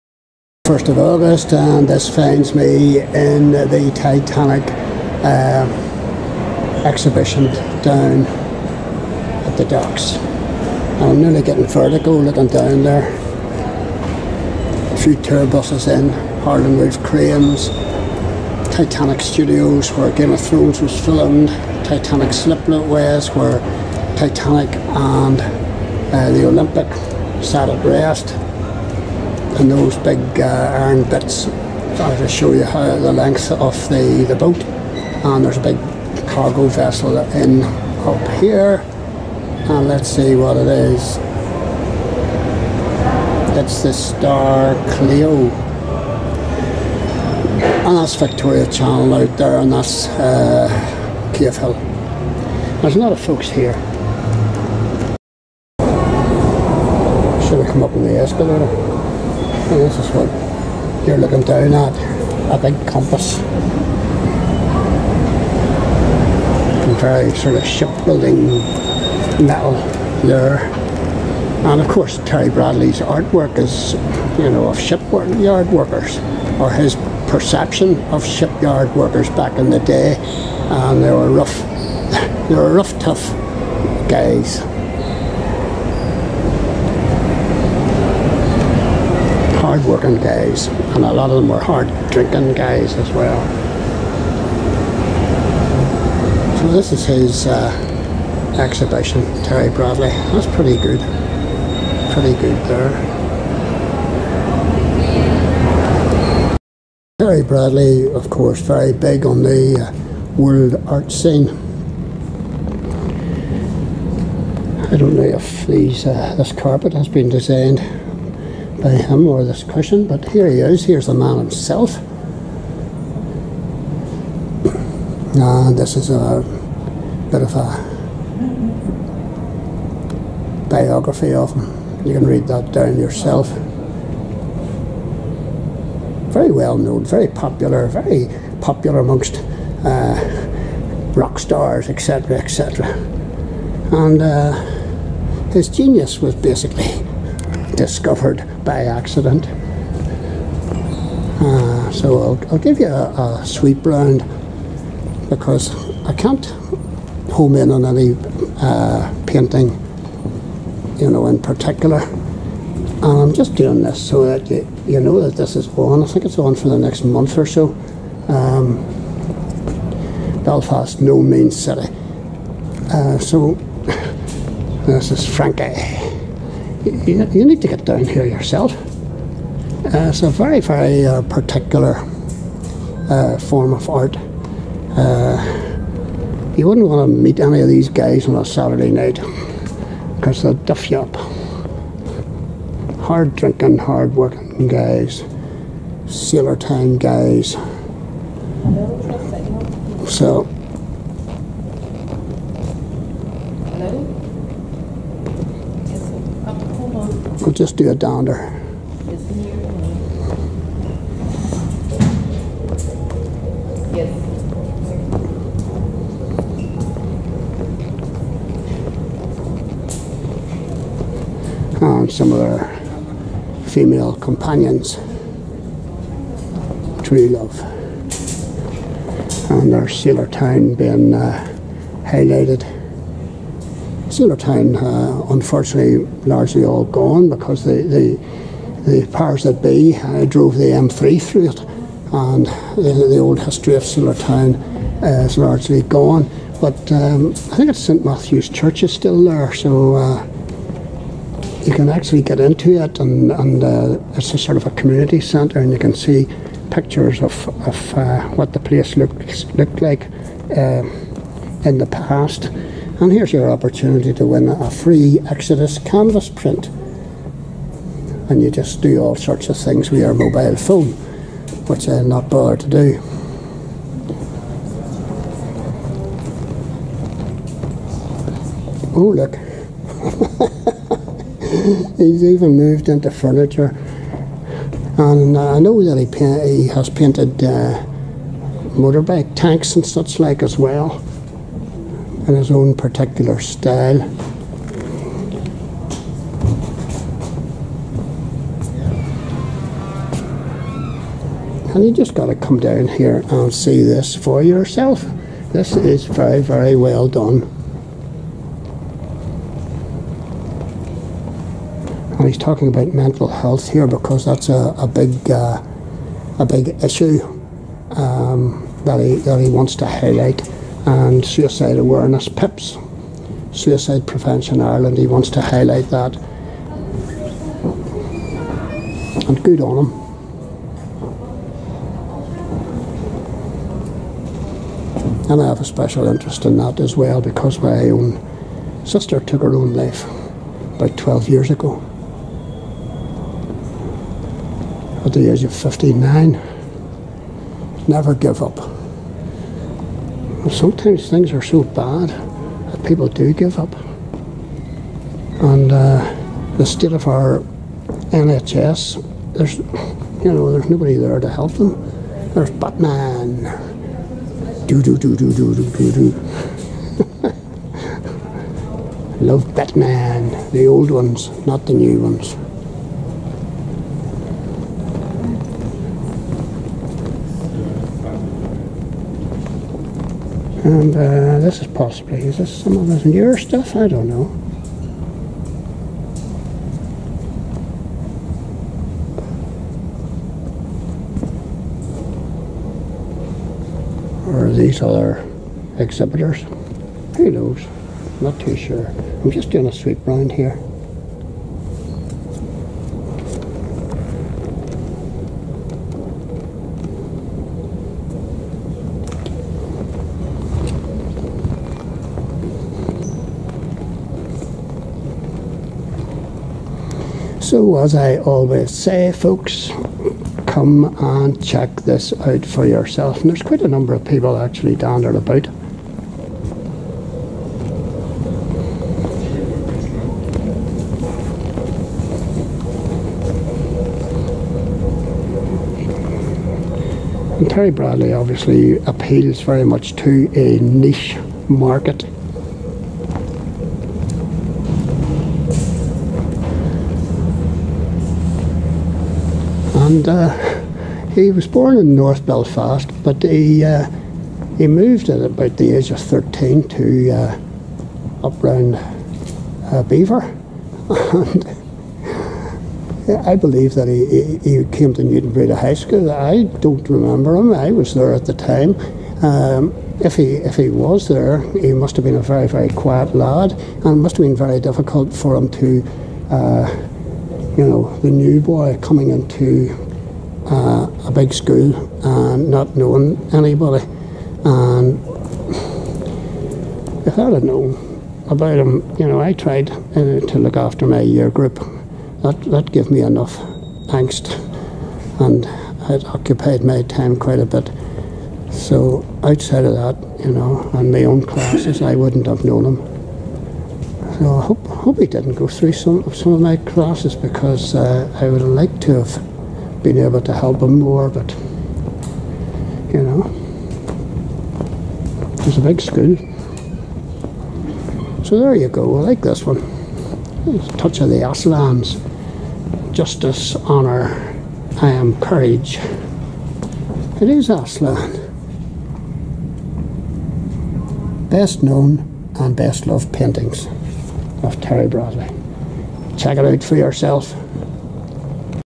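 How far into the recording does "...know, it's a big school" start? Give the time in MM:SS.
08:33.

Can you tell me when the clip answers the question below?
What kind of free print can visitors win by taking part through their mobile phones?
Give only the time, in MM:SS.
04:25.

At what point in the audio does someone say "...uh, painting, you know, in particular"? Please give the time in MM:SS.
02:38.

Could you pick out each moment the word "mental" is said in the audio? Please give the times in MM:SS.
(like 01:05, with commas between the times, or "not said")
05:12.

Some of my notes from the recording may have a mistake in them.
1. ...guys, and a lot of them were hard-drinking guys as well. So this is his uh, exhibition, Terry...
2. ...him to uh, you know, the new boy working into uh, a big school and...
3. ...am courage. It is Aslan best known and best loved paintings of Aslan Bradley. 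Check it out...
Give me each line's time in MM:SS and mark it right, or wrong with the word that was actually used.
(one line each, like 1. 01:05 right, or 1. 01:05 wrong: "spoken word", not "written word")
1. 01:30 right
2. 07:55 wrong: "coming", not "working"
3. 08:44 wrong: "Terry", not "Aslan".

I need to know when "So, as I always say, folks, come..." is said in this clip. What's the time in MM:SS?
06:57.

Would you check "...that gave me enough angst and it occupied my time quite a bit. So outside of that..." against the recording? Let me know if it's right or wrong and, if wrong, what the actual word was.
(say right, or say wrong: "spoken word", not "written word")
right.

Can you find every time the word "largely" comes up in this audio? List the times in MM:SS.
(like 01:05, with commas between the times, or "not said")
03:56, 04:05.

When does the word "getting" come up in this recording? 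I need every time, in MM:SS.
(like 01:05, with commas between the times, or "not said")
00:11.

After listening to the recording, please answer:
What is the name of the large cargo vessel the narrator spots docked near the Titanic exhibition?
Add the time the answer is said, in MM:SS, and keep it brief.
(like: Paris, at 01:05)
Star Cleo, at 00:43.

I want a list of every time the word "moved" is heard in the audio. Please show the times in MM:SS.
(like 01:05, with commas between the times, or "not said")
04:42, 07:34.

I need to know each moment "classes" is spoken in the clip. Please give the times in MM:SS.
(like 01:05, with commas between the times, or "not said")
08:21, 08:26.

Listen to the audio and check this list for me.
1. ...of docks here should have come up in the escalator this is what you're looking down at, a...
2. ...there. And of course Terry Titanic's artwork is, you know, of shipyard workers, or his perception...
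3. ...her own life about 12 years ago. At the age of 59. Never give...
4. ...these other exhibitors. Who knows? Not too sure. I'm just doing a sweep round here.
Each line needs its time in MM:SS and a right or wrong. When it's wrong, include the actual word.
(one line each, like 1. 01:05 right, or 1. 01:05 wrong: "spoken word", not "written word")
1. 00:53 wrong: "folks", not "docks"
2. 01:10 wrong: "Bradley", not "Titanic"
3. 05:39 right
4. 06:34 right.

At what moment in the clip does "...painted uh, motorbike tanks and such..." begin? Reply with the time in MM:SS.
04:46.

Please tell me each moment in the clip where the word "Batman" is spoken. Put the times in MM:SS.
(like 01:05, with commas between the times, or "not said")
06:02, 06:09.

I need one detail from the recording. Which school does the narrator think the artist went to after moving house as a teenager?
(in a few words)
Newtownbreda High School.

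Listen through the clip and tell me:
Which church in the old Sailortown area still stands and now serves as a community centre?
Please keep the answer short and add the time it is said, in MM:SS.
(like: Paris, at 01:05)
St Matthew's Church, at 04:07.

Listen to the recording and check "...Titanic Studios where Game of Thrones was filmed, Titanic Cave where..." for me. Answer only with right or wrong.
wrong.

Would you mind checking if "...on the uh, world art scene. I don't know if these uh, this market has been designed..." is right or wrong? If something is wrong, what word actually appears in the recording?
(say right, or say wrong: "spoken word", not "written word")
wrong: "carpet", not "market".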